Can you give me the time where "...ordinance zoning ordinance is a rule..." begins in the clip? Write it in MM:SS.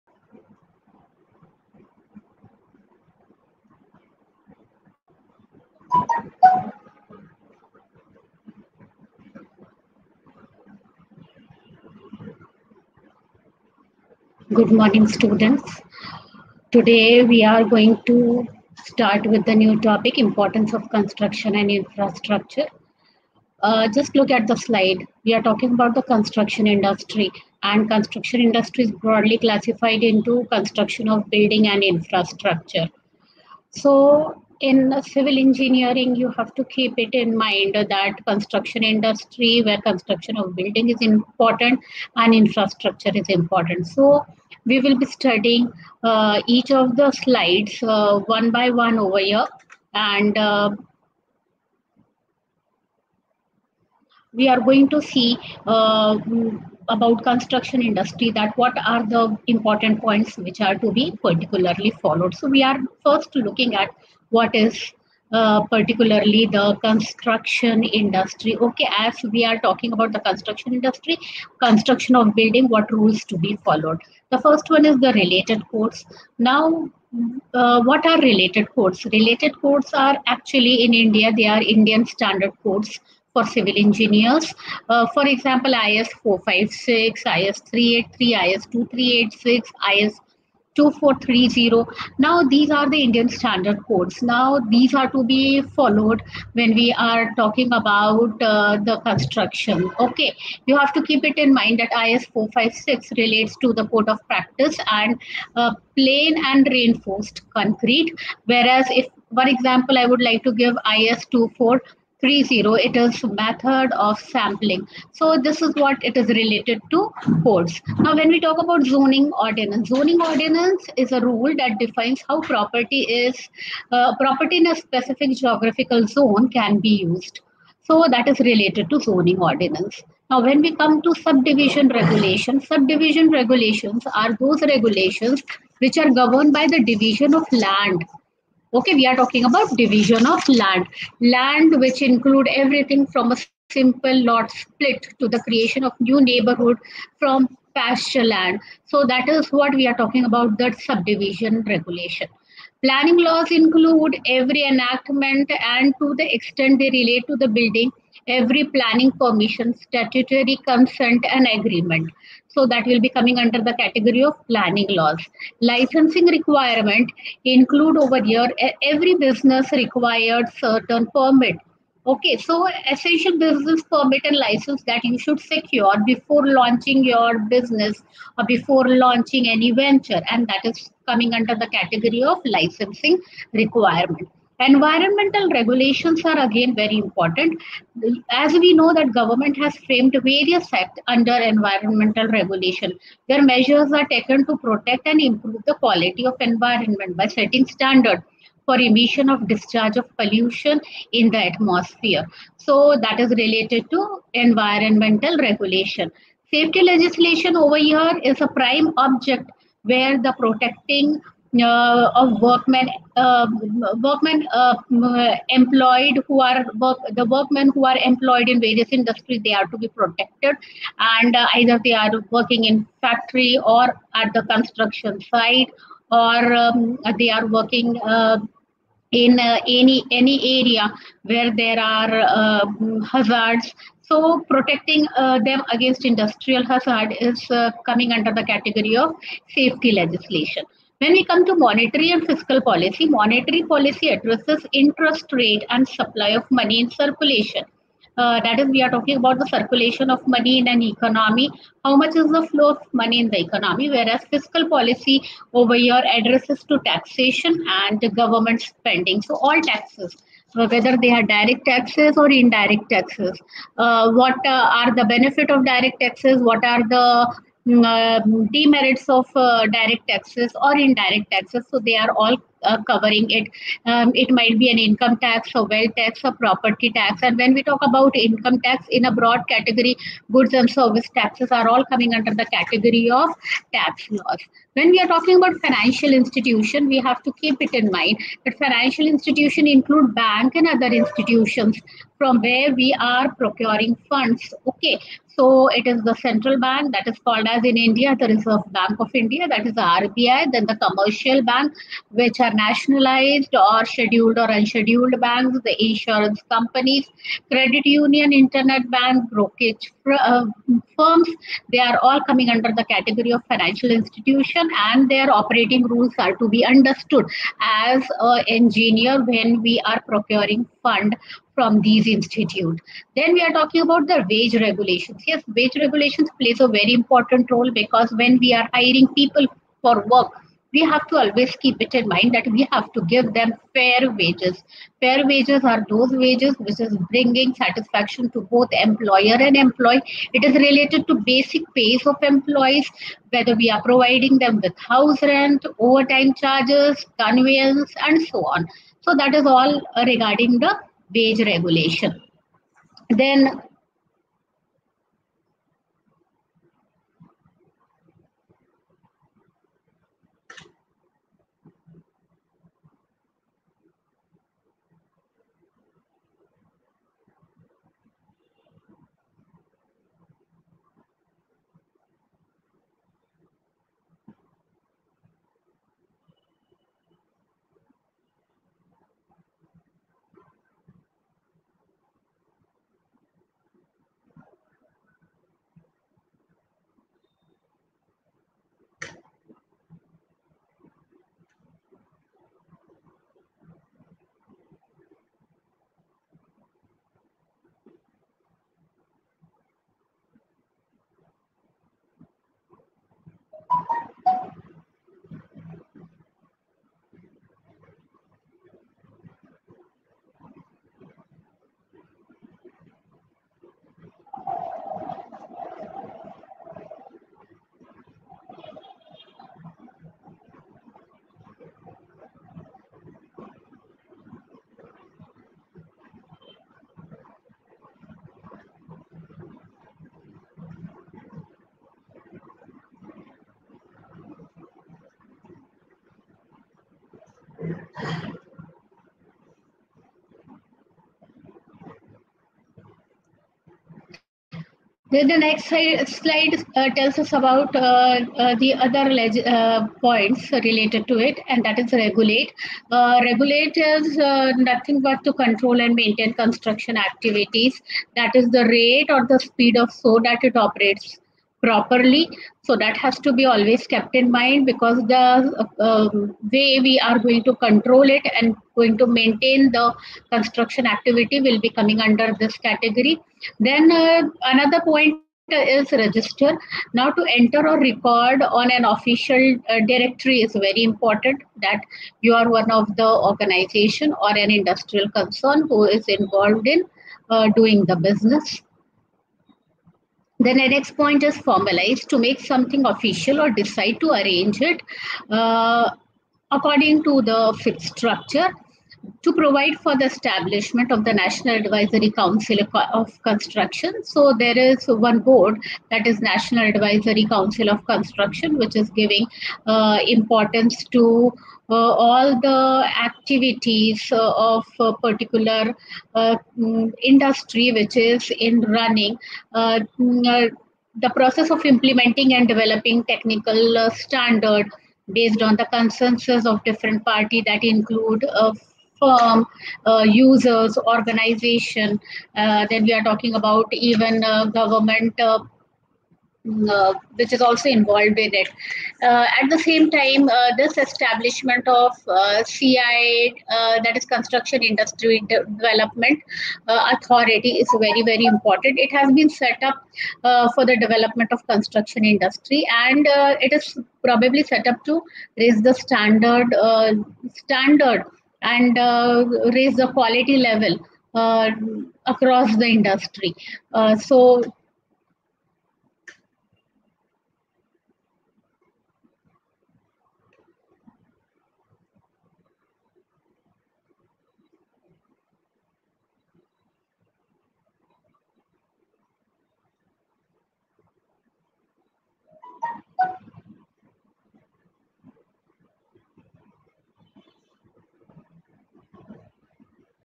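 01:59.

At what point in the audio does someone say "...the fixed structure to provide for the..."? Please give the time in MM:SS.
08:17.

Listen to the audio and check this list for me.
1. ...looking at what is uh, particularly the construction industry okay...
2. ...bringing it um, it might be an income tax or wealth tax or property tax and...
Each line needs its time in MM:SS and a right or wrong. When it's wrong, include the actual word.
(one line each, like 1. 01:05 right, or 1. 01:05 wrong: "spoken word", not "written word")
1. 01:03 right
2. 04:32 wrong: "covering", not "bringing".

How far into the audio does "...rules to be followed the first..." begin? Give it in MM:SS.
01:12.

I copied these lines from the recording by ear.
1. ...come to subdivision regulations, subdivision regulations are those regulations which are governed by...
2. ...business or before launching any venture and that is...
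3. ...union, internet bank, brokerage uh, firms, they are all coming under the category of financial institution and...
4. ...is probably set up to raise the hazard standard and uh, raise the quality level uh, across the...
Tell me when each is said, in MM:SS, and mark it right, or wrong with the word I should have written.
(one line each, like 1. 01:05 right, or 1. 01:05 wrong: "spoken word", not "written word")
1. 02:10 right
2. 02:57 right
3. 05:07 right
4. 09:13 wrong: "standard", not "hazard".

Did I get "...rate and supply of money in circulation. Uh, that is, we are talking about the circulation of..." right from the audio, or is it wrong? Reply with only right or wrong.
right.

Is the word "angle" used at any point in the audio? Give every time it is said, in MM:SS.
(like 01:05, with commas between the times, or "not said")
not said.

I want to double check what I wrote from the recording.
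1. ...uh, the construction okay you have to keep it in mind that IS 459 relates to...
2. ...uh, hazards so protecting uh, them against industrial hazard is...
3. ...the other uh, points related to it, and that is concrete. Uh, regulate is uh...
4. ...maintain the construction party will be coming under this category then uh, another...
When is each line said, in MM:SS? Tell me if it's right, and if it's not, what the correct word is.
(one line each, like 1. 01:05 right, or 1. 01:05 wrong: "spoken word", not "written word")
1. 01:38 wrong: "456", not "459"
2. 03:52 right
3. 07:28 wrong: "regulate", not "concrete"
4. 07:49 wrong: "activity", not "party".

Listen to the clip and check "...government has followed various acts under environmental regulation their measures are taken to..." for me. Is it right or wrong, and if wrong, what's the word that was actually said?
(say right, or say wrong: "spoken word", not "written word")
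wrong: "framed", not "followed".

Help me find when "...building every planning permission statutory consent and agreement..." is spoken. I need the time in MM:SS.
02:37.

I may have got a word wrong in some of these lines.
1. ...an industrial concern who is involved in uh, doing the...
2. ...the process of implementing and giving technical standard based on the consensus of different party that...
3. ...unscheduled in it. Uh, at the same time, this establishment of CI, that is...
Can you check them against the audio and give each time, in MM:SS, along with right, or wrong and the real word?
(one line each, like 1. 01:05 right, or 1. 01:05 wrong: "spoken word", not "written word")
1. 08:04 right
2. 08:40 wrong: "developing", not "giving"
3. 08:57 wrong: "involved", not "unscheduled".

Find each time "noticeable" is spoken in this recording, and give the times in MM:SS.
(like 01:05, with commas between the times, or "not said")
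not said.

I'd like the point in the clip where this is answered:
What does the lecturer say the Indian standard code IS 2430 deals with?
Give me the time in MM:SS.
01:53.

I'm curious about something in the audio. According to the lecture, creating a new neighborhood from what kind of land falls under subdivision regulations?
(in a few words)
Pasture land.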